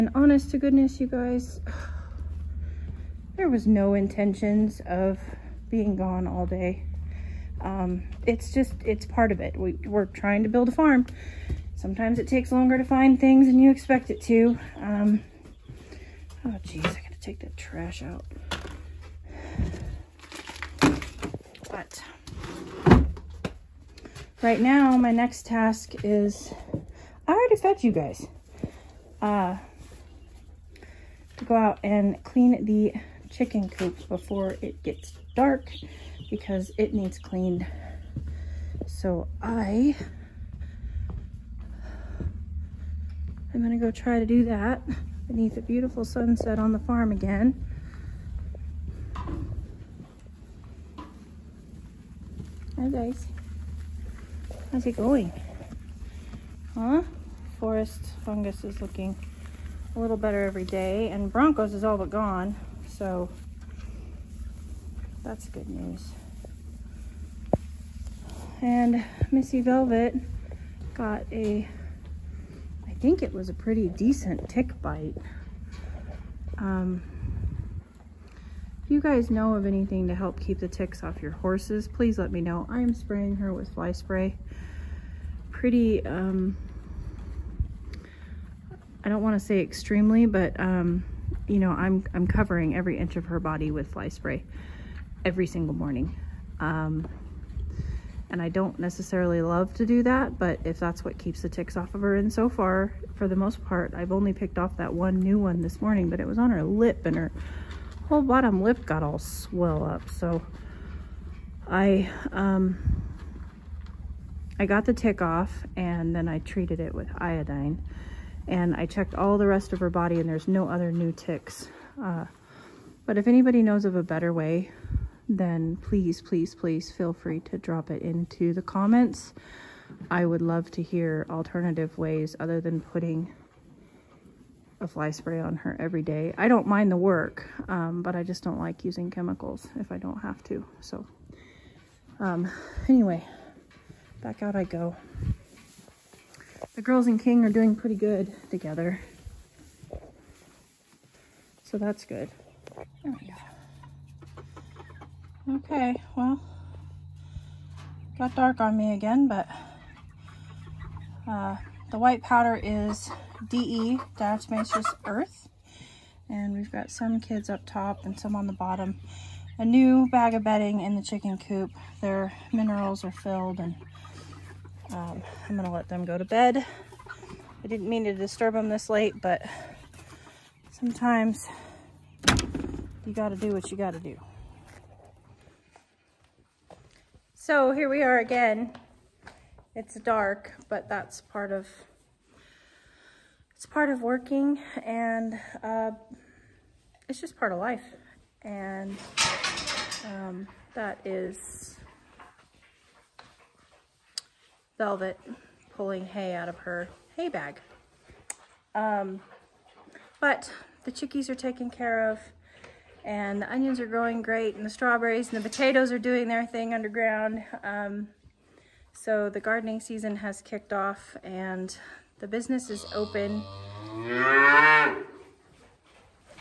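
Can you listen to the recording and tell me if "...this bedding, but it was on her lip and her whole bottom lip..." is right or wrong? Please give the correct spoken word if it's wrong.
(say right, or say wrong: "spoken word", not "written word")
wrong: "morning", not "bedding".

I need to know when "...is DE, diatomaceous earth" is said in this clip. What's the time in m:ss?
2:42.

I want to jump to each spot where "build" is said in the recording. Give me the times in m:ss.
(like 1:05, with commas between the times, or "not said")
0:10.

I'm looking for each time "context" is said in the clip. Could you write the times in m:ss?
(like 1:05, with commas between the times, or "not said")
not said.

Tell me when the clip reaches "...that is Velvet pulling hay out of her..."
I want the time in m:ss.
3:20.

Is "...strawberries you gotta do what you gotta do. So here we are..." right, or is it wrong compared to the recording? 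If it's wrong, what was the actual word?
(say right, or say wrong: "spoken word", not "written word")
wrong: "sometimes", not "strawberries".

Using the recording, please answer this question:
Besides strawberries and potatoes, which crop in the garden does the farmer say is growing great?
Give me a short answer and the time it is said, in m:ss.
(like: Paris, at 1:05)
Onions, at 3:33.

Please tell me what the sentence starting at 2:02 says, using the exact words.
Uh, but if anybody knows of a better way, then please, please, please feel free to drop it into the comments.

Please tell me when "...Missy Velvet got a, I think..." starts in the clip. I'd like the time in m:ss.
1:09.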